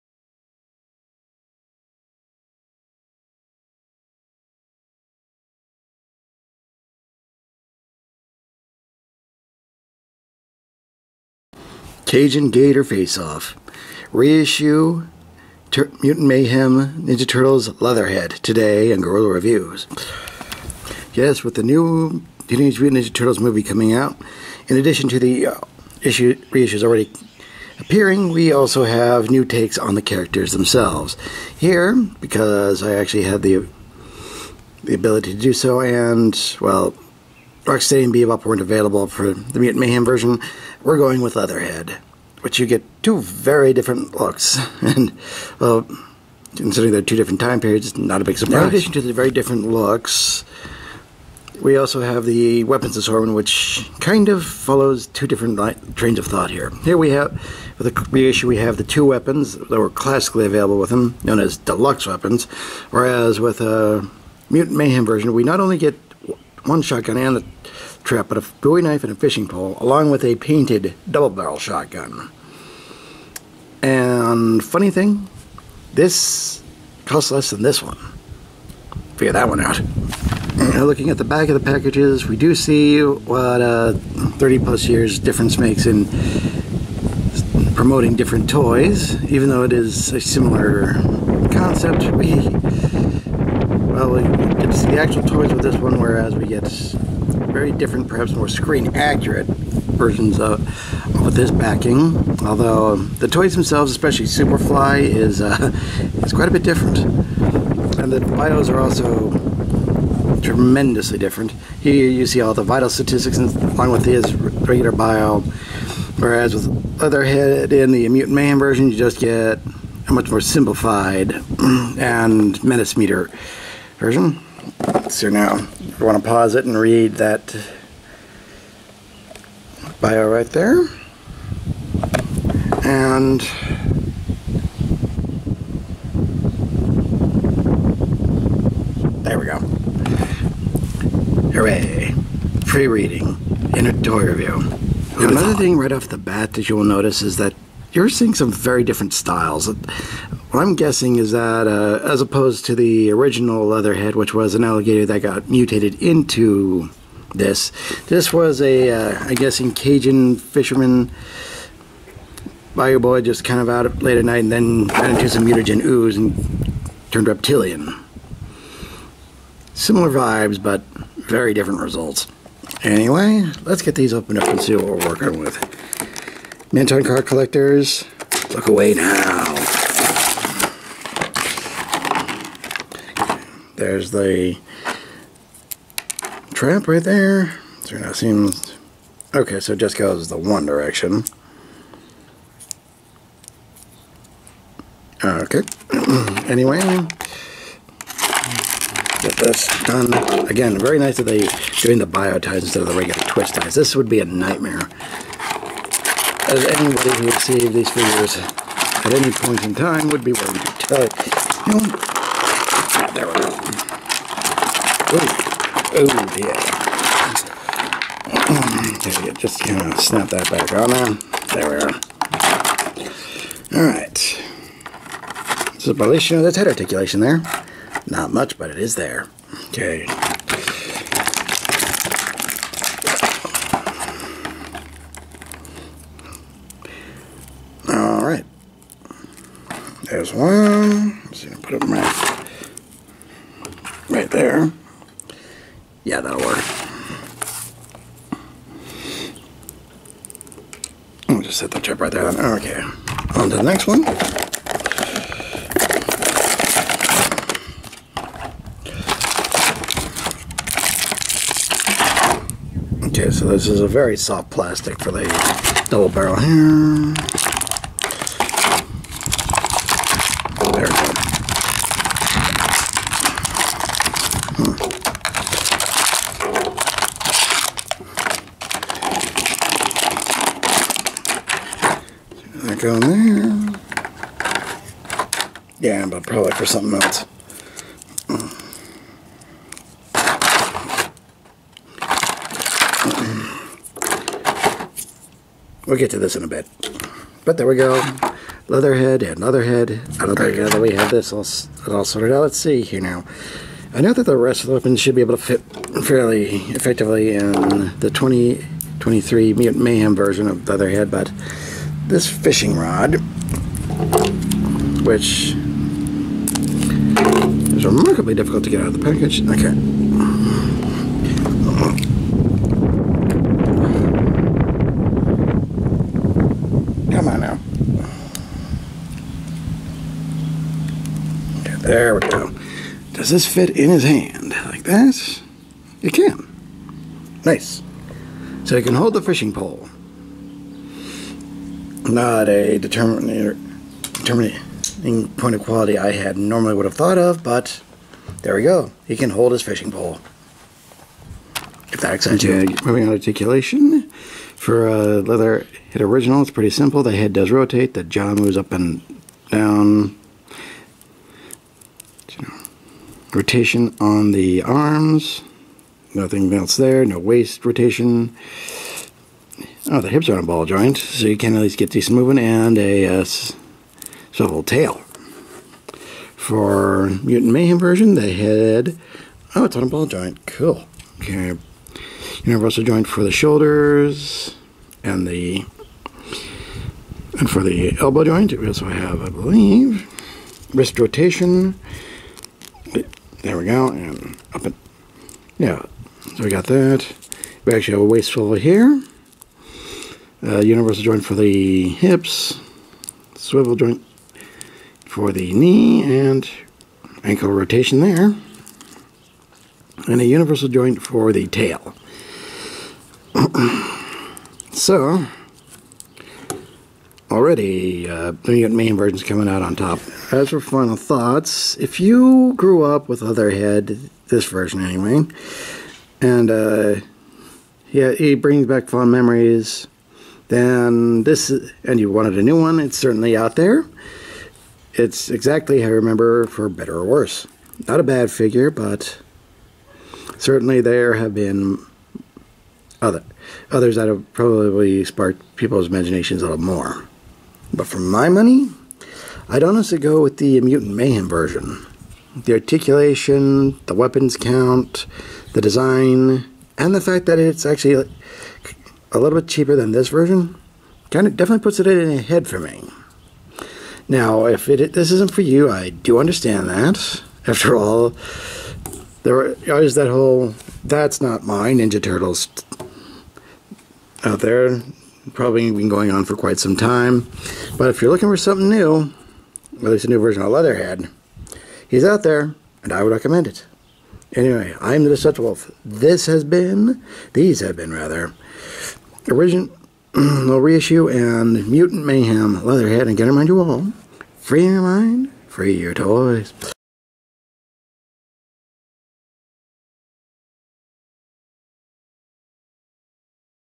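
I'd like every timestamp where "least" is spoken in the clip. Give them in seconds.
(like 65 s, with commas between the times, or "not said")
371 s, 479 s.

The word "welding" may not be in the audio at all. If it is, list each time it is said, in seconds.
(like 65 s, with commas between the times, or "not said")
not said.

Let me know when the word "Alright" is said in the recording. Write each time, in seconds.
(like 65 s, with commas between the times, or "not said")
223 s, 237 s.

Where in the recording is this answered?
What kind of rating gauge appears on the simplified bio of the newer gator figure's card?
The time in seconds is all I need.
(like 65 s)
122 s.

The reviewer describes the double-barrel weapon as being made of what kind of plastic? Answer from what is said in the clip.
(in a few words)
very soft plastic.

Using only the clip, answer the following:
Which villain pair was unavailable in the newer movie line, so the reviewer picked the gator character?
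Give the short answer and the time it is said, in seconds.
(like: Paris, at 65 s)
Rocksteady and Bebop, at 37 s.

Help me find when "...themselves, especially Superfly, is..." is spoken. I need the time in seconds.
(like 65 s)
103 s.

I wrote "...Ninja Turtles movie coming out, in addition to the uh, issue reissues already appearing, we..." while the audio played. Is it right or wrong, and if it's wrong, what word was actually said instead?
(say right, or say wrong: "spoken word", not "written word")
right.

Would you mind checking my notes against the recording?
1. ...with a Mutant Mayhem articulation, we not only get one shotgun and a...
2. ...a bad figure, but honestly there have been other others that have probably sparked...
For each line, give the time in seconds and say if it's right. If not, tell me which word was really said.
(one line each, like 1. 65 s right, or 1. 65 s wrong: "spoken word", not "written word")
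1. 63 s wrong: "version", not "articulation"
2. 438 s wrong: "certainly", not "honestly".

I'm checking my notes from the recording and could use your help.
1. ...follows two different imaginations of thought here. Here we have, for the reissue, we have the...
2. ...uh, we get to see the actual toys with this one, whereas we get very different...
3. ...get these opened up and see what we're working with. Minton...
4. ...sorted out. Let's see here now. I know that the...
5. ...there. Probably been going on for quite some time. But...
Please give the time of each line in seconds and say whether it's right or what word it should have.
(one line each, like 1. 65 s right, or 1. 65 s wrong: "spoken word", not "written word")
1. 54 s wrong: "trains", not "imaginations"
2. 94 s right
3. 173 s right
4. 302 s right
5. 474 s right.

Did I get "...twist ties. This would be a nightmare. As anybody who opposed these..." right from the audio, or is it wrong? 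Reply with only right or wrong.
wrong.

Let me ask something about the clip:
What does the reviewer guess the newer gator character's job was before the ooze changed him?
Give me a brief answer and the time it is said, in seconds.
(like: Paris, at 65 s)
Cajun fisherman, at 159 s.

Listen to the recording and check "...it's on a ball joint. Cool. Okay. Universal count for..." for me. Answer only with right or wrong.
wrong.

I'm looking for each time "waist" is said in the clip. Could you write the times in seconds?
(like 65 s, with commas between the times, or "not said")
367 s, 398 s.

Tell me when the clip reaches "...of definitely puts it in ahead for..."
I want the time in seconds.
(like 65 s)
461 s.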